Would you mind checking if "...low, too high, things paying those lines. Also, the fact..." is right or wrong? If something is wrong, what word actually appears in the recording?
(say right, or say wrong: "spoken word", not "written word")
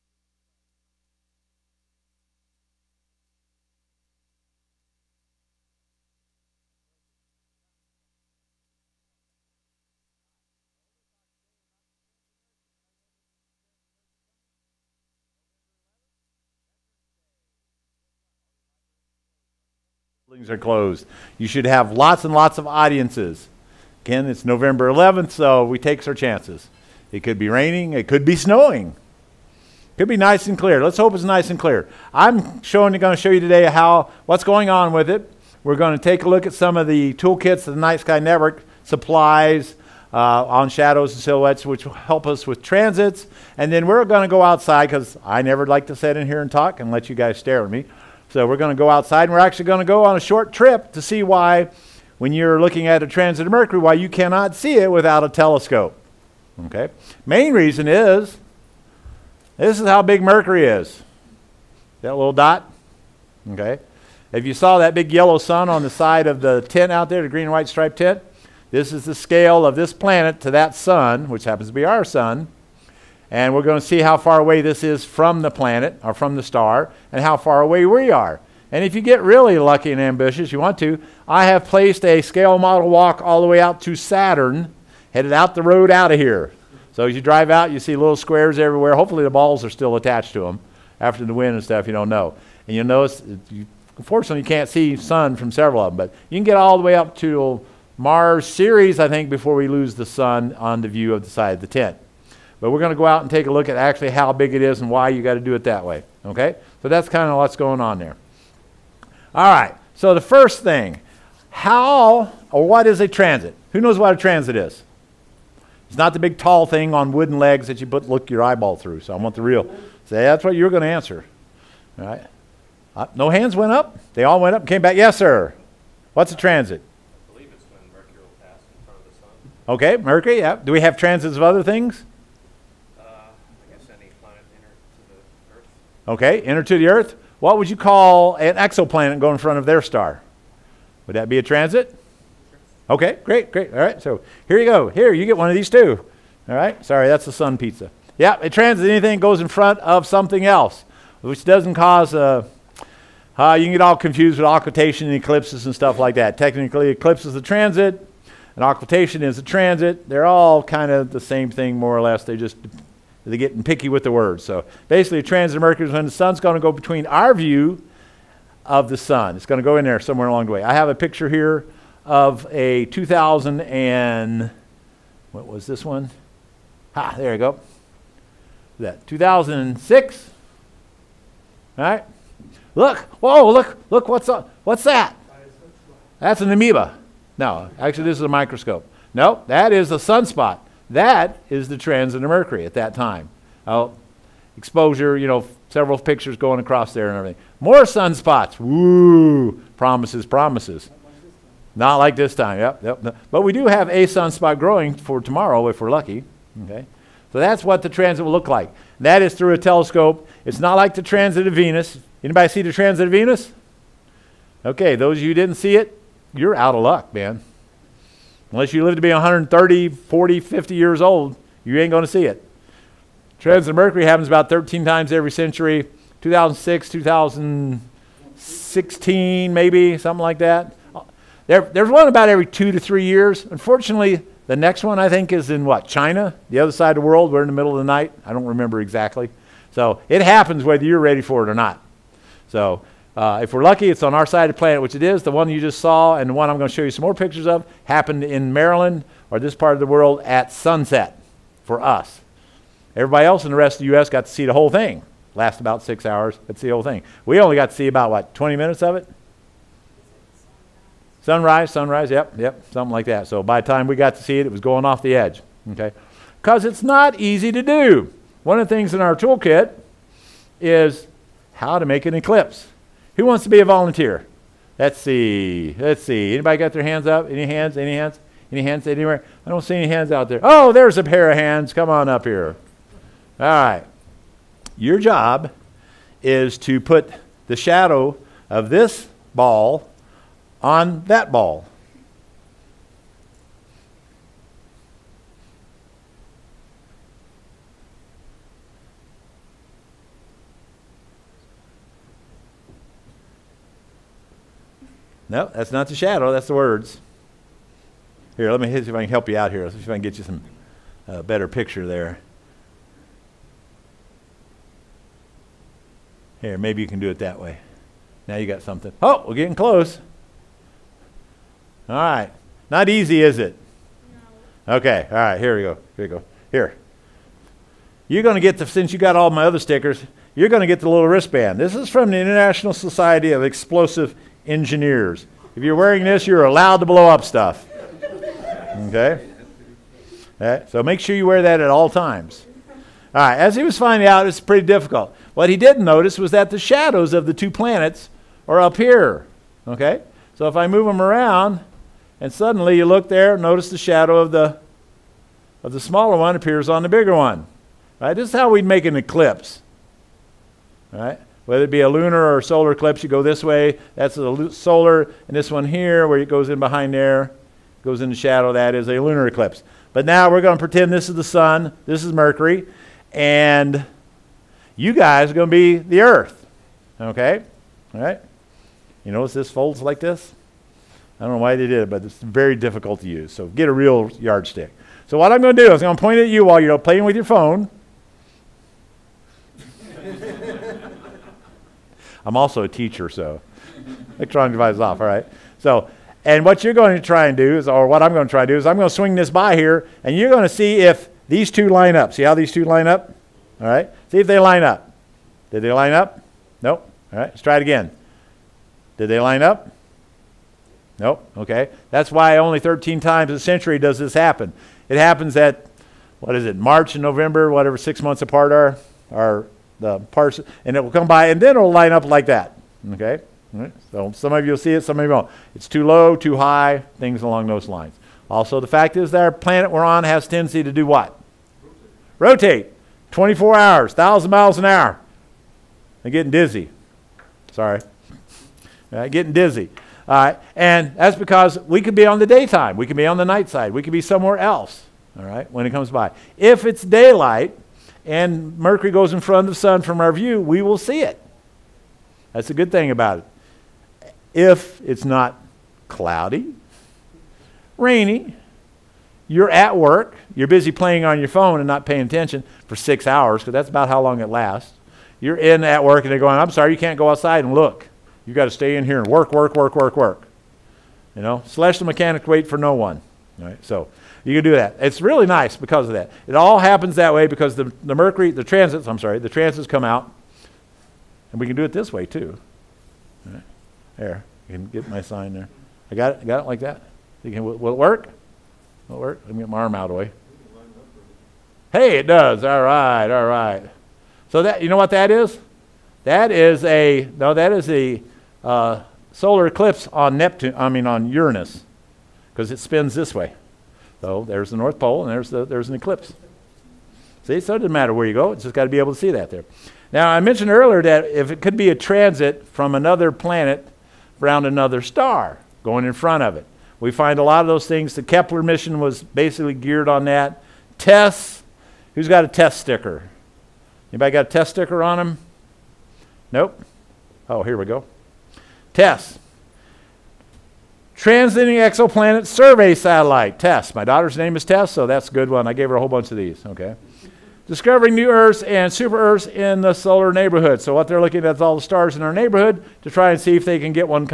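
wrong: "along", not "paying".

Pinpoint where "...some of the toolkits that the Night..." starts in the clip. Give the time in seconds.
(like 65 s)
36 s.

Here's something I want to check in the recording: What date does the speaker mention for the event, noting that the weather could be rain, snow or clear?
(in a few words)
November 11th.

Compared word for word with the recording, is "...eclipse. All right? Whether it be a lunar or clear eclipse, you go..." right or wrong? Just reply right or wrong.
wrong.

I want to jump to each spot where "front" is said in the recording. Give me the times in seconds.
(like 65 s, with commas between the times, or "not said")
128 s, 139 s, 149 s, 449 s, 515 s.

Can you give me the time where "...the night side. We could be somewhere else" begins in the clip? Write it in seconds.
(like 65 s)
443 s.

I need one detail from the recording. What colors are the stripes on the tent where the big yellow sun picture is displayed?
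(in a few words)
green and white.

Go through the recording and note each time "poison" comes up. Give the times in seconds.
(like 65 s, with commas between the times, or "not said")
not said.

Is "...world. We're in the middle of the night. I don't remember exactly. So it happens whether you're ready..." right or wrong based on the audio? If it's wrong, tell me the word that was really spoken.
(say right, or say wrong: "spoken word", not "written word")
right.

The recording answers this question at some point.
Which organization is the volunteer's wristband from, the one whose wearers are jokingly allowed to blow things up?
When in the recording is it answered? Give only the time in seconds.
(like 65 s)
332 s.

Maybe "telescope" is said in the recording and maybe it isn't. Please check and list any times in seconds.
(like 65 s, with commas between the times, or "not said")
55 s, 209 s.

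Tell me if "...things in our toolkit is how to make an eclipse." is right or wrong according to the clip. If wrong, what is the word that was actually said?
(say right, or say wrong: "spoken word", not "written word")
right.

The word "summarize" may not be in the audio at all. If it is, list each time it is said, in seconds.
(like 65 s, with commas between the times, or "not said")
not said.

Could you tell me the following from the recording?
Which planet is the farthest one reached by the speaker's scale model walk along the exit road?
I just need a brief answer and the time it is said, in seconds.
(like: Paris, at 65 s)
Saturn, at 83 s.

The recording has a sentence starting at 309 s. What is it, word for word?
Let's see if I can get you some uh, better picture there.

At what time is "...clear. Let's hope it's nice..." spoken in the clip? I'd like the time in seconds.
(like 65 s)
30 s.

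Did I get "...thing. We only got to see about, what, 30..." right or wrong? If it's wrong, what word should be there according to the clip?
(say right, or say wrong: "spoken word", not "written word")
wrong: "20", not "30".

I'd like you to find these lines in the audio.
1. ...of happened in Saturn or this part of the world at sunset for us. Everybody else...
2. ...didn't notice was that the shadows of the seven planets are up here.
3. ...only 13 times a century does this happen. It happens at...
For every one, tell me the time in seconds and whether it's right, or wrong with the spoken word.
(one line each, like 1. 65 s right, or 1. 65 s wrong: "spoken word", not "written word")
1. 247 s wrong: "Maryland", not "Saturn"
2. 345 s wrong: "two", not "seven"
3. 412 s right.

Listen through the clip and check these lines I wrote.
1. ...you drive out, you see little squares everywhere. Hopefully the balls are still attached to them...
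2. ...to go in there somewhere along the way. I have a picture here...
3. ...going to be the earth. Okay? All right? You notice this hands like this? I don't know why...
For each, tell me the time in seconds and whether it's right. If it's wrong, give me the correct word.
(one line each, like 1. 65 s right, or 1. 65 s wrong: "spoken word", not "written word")
1. 87 s right
2. 169 s right
3. 375 s wrong: "folds", not "hands".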